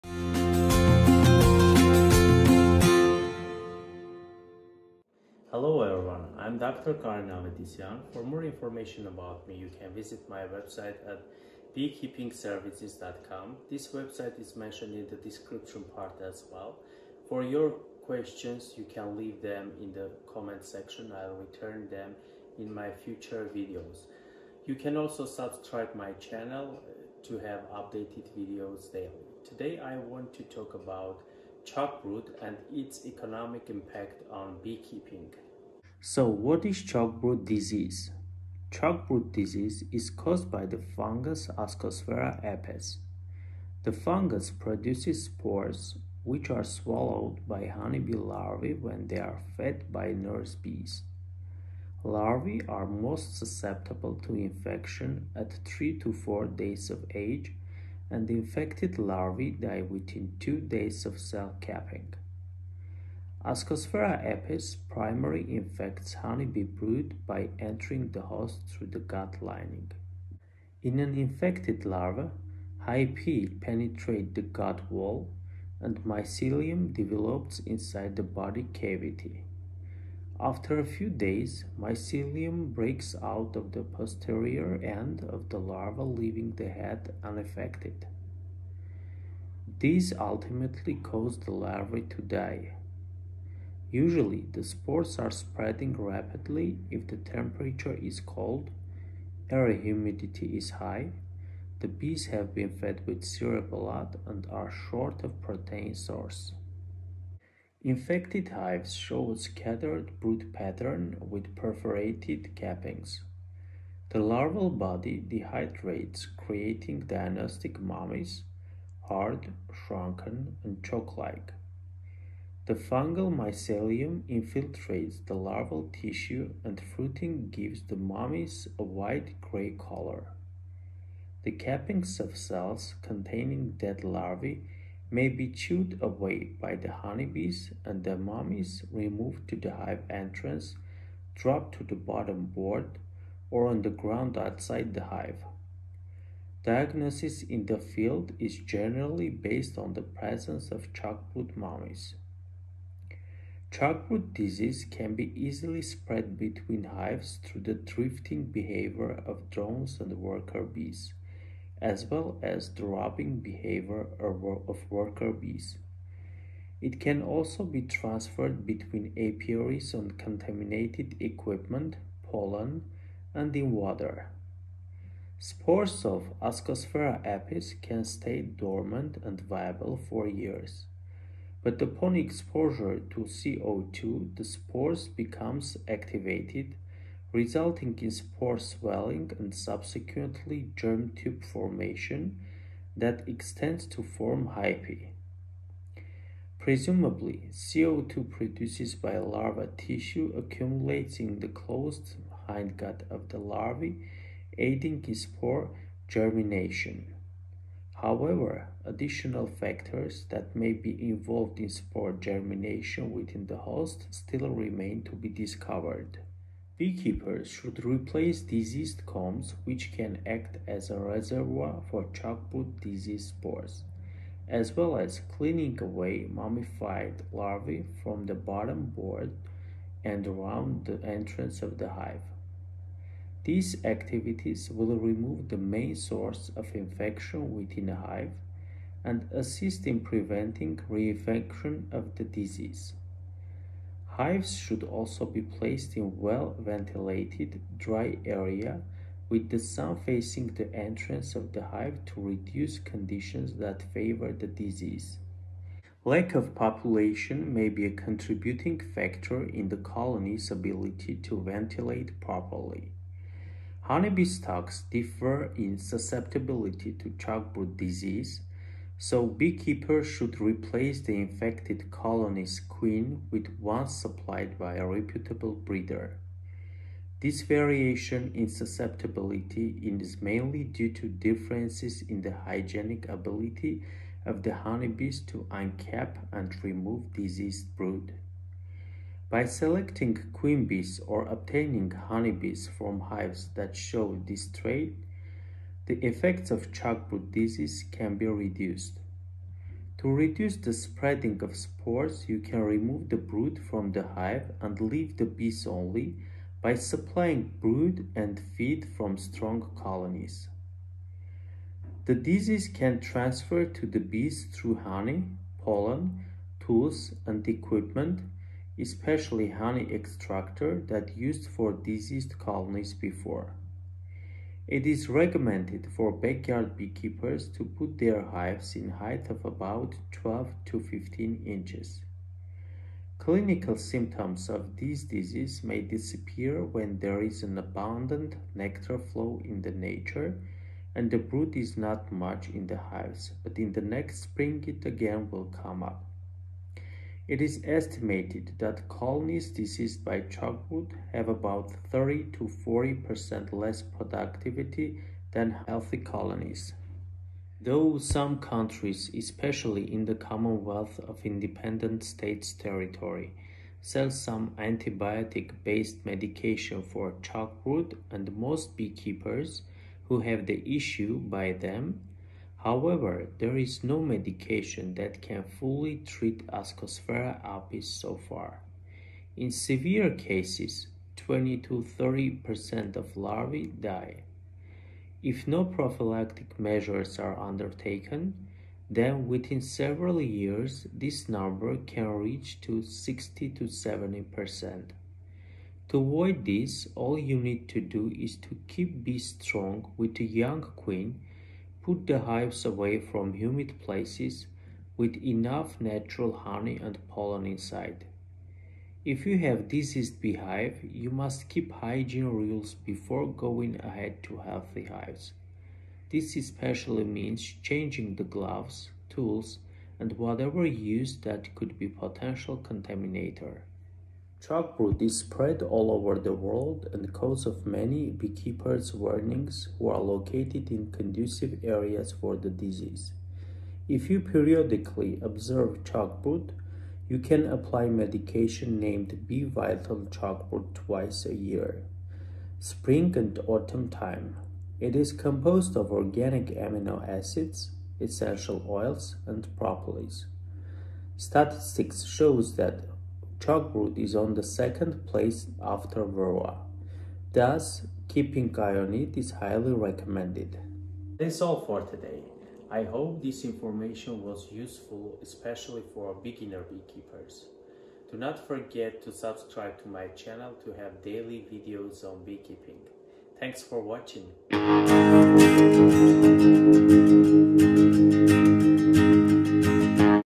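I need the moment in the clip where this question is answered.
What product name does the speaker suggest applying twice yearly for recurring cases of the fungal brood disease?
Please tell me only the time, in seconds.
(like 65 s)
439 s.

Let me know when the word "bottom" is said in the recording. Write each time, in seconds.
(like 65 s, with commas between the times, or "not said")
142 s, 228 s.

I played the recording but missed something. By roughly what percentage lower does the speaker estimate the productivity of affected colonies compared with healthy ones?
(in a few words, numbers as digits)
30 to 40%.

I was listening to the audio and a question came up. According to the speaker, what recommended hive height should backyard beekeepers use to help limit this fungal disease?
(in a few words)
12 to 15 inches.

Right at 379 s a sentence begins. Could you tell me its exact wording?
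In severe cases, 20 to 30% of larvae die.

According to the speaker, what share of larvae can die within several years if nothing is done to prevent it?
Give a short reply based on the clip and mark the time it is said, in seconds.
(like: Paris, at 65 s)
60 to 70%, at 392 s.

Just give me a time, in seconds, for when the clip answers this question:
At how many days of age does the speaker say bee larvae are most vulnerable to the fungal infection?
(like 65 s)
55 s.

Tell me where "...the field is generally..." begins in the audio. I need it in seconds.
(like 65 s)
147 s.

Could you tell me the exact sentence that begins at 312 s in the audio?
The disease can transfer to the bees through honey, pollen, tools and equipment especially honey extractor that used for diseased colonies before.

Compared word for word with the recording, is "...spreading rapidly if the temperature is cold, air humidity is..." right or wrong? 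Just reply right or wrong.
right.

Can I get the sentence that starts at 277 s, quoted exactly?
This variation in susceptibility is mainly due to differences in the hygienic ability of the honeybees to uncap and remove diseased brood.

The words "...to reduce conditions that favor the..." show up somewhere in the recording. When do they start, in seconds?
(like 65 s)
252 s.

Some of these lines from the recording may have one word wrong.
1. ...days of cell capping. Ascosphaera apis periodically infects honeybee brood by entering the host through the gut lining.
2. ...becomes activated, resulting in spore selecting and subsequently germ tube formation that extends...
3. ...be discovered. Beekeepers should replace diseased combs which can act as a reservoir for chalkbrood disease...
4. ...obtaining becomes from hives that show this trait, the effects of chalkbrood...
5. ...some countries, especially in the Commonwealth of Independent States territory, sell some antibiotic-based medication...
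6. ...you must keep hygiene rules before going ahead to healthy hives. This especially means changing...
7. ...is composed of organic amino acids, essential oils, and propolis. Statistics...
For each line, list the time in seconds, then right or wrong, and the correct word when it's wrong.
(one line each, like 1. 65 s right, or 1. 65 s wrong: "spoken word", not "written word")
1. 60 s wrong: "primarily", not "periodically"
2. 185 s wrong: "swelling", not "selecting"
3. 215 s right
4. 291 s wrong: "honeybees", not "becomes"
5. 357 s right
6. 410 s right
7. 444 s right.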